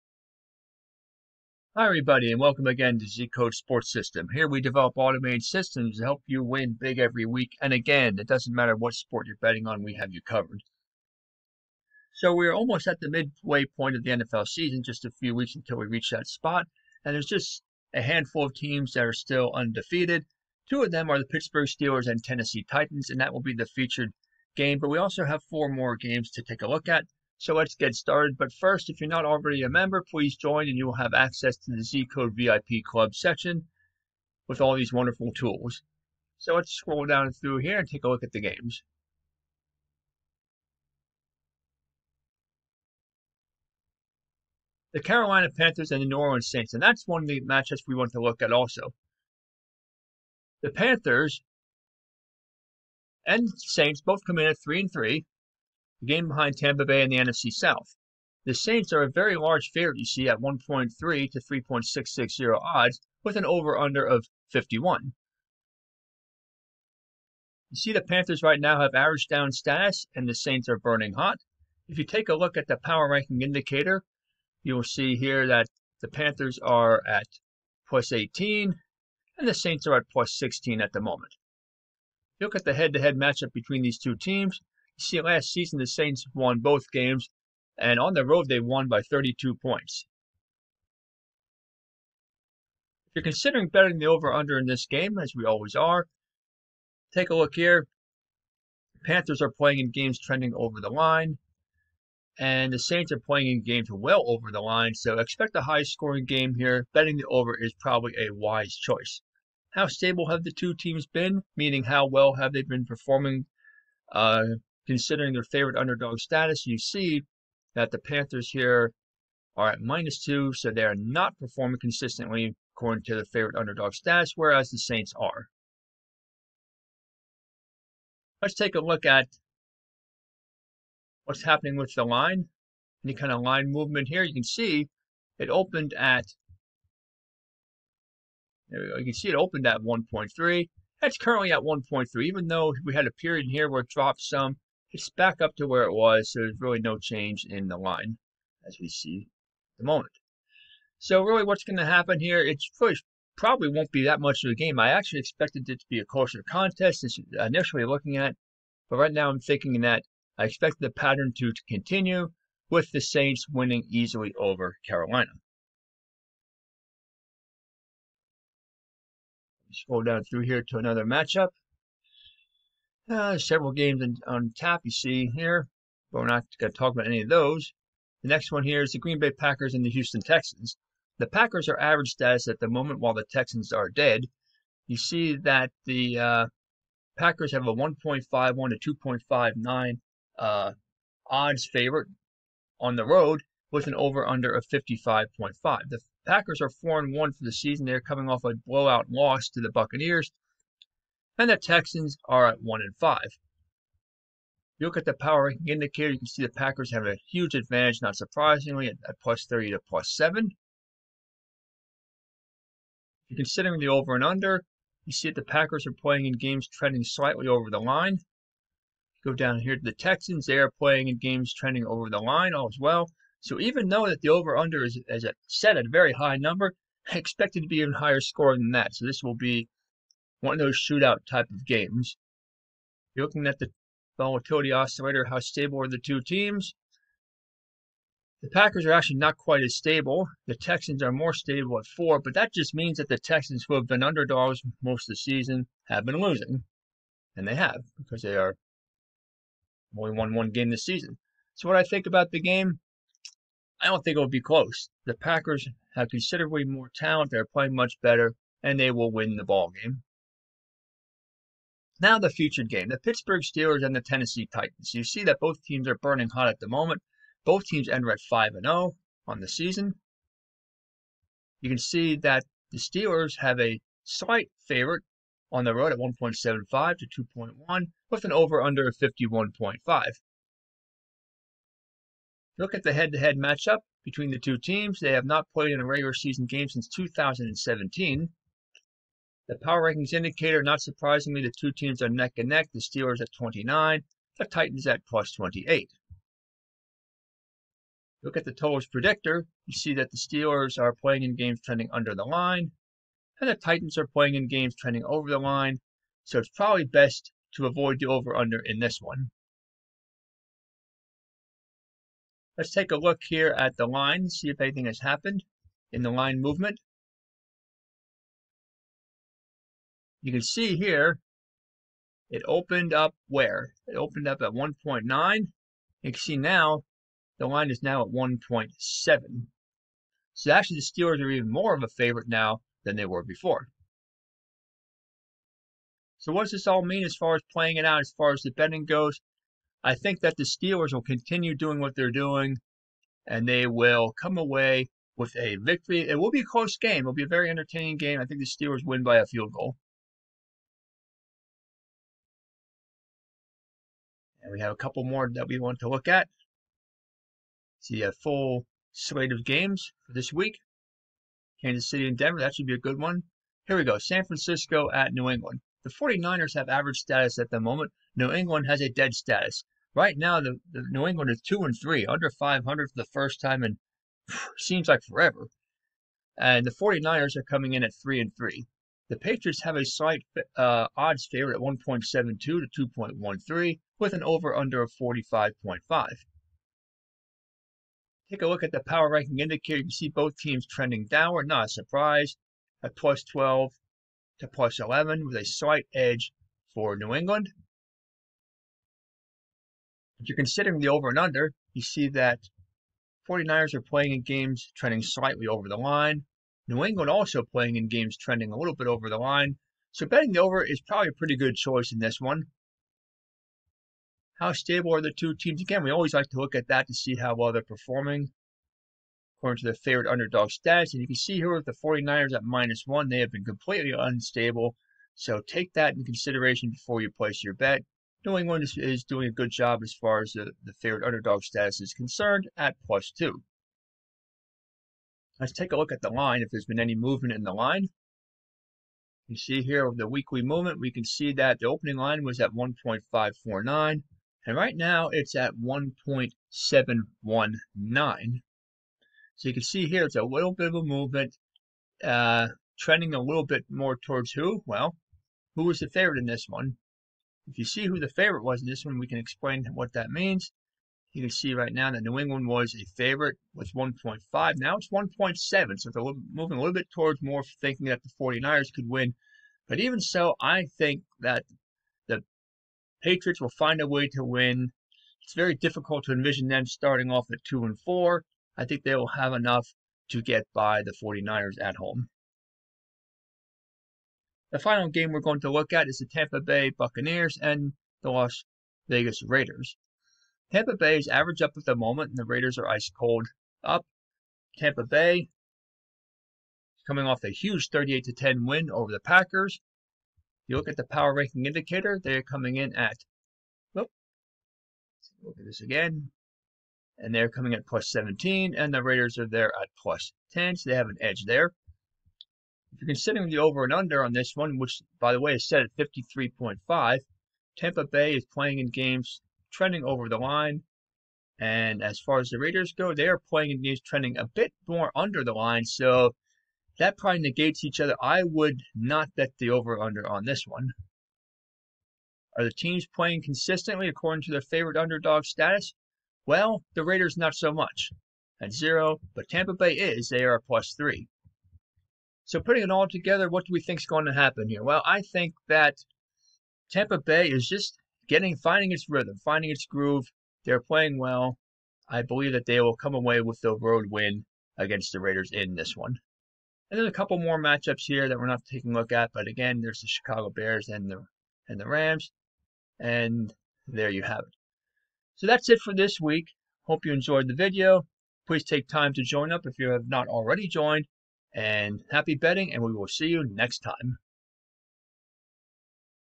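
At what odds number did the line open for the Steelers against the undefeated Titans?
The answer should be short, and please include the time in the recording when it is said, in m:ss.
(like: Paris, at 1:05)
1.9, at 5:24.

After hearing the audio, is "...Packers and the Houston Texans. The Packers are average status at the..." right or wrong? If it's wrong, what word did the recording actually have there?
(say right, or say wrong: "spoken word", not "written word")
right.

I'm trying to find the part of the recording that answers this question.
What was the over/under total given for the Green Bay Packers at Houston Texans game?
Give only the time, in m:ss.
3:14.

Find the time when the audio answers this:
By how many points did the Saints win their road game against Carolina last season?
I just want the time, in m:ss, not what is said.
1:29.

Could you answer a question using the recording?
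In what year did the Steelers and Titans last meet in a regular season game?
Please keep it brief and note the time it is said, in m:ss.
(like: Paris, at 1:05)
2017, at 4:46.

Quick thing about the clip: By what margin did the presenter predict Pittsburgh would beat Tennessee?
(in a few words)
a field goal.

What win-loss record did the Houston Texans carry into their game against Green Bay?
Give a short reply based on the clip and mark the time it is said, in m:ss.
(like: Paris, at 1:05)
1 and 5, at 3:22.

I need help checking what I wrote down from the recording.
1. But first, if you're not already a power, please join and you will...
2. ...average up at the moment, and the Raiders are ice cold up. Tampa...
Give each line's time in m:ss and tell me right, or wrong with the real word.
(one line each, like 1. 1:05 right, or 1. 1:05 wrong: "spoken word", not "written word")
1. 0:28 wrong: "member", not "power"
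2. 8:11 right.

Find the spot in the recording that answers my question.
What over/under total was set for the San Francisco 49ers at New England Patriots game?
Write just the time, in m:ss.
6:24.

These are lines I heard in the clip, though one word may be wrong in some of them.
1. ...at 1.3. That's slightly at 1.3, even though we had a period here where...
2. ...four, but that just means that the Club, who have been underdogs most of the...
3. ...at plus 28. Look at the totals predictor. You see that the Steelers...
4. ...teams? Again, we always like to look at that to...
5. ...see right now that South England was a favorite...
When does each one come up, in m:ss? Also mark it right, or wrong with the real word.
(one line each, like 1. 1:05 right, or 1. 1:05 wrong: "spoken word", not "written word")
1. 2:19 wrong: "currently", not "slightly"
2. 4:01 wrong: "Texans", not "Club"
3. 4:54 right
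4. 6:55 right
5. 7:41 wrong: "New", not "South".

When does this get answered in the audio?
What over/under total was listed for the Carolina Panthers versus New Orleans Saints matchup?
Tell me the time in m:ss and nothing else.
1:03.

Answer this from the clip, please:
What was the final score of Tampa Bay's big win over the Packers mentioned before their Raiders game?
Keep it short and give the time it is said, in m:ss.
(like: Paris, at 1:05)
38 to 10, at 8:17.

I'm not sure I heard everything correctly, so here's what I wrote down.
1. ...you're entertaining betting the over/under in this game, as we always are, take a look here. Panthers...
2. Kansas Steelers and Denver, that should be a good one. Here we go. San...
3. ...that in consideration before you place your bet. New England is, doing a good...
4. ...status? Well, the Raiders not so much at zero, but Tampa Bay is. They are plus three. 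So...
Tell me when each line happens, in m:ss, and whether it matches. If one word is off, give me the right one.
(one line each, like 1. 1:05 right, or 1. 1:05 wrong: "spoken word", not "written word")
1. 1:33 wrong: "considering", not "entertaining"
2. 6:01 wrong: "City", not "Steelers"
3. 7:05 right
4. 8:55 right.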